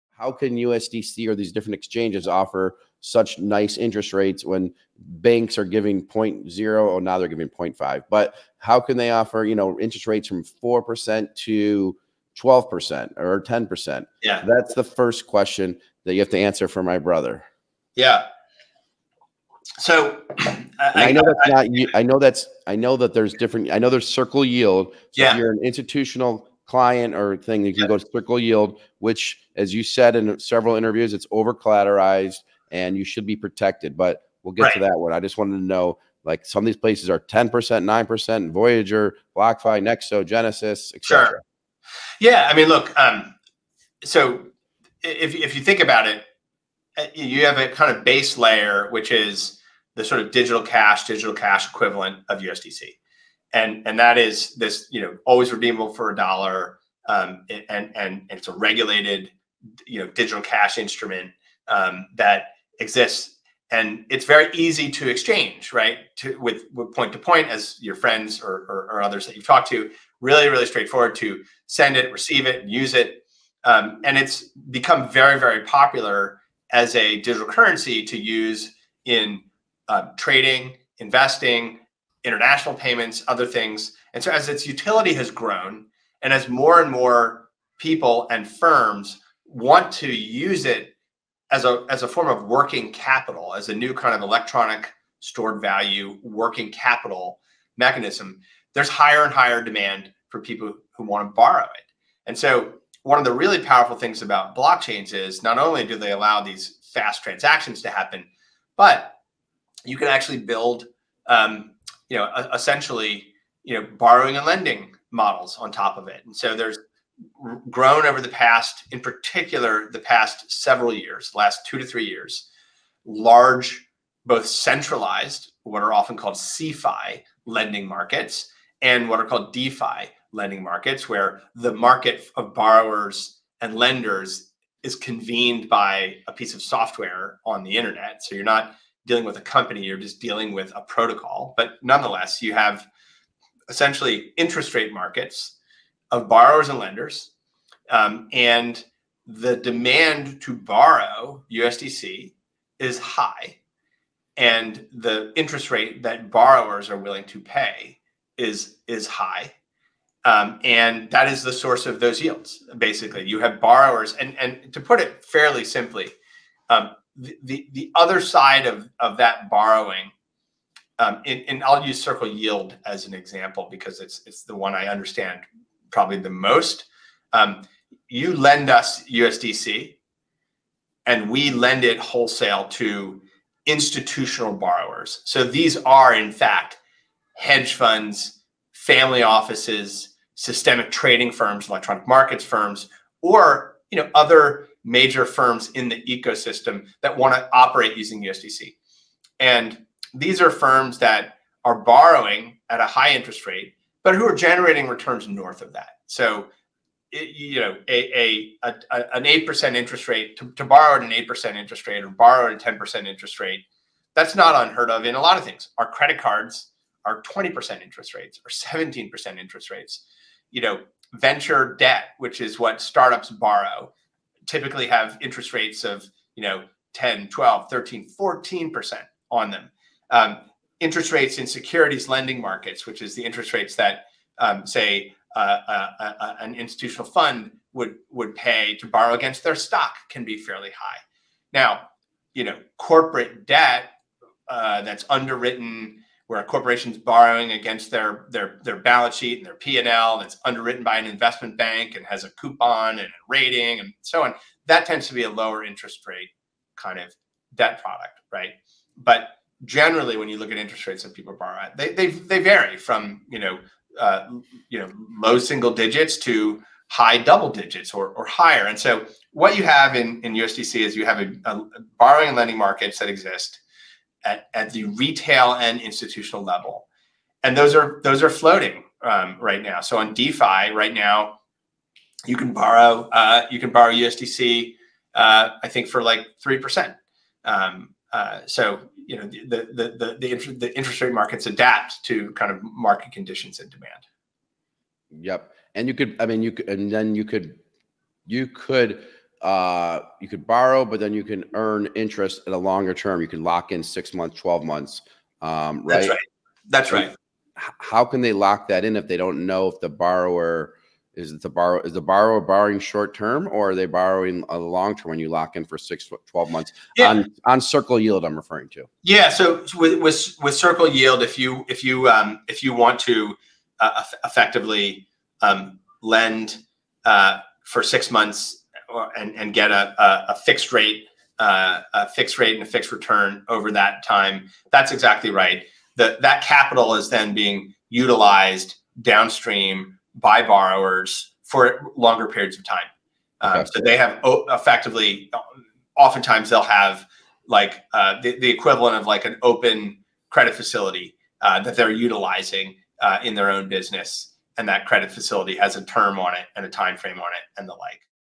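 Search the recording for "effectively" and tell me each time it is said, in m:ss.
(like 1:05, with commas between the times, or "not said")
5:24, 5:44.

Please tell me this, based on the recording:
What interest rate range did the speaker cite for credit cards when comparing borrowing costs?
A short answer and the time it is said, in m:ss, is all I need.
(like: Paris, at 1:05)
20% or 17%, at 3:37.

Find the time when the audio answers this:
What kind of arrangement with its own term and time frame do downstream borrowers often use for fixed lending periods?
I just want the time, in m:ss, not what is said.
5:49.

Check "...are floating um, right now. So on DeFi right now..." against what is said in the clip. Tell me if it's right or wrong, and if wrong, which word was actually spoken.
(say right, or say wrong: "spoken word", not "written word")
right.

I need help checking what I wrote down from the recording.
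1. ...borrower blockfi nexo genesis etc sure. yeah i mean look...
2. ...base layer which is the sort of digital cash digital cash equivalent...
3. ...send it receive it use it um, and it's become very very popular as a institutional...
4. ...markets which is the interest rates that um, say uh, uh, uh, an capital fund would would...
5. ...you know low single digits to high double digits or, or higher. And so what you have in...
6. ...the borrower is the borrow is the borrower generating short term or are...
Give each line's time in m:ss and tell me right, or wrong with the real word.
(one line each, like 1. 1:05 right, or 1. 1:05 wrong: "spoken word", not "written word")
1. 0:38 wrong: "voyager", not "borrower"
2. 0:48 right
3. 1:11 wrong: "digital", not "institutional"
4. 3:52 wrong: "institutional", not "capital"
5. 4:24 right
6. 5:09 wrong: "borrowing", not "generating".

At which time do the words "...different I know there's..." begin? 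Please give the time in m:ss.
0:23.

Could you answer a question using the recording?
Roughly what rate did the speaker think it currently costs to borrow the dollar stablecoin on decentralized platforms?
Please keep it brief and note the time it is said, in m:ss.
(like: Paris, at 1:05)
3%, at 4:46.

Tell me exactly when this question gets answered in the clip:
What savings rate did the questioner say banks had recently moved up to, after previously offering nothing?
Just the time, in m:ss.
0:07.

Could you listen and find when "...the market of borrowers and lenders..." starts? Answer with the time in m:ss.
2:11.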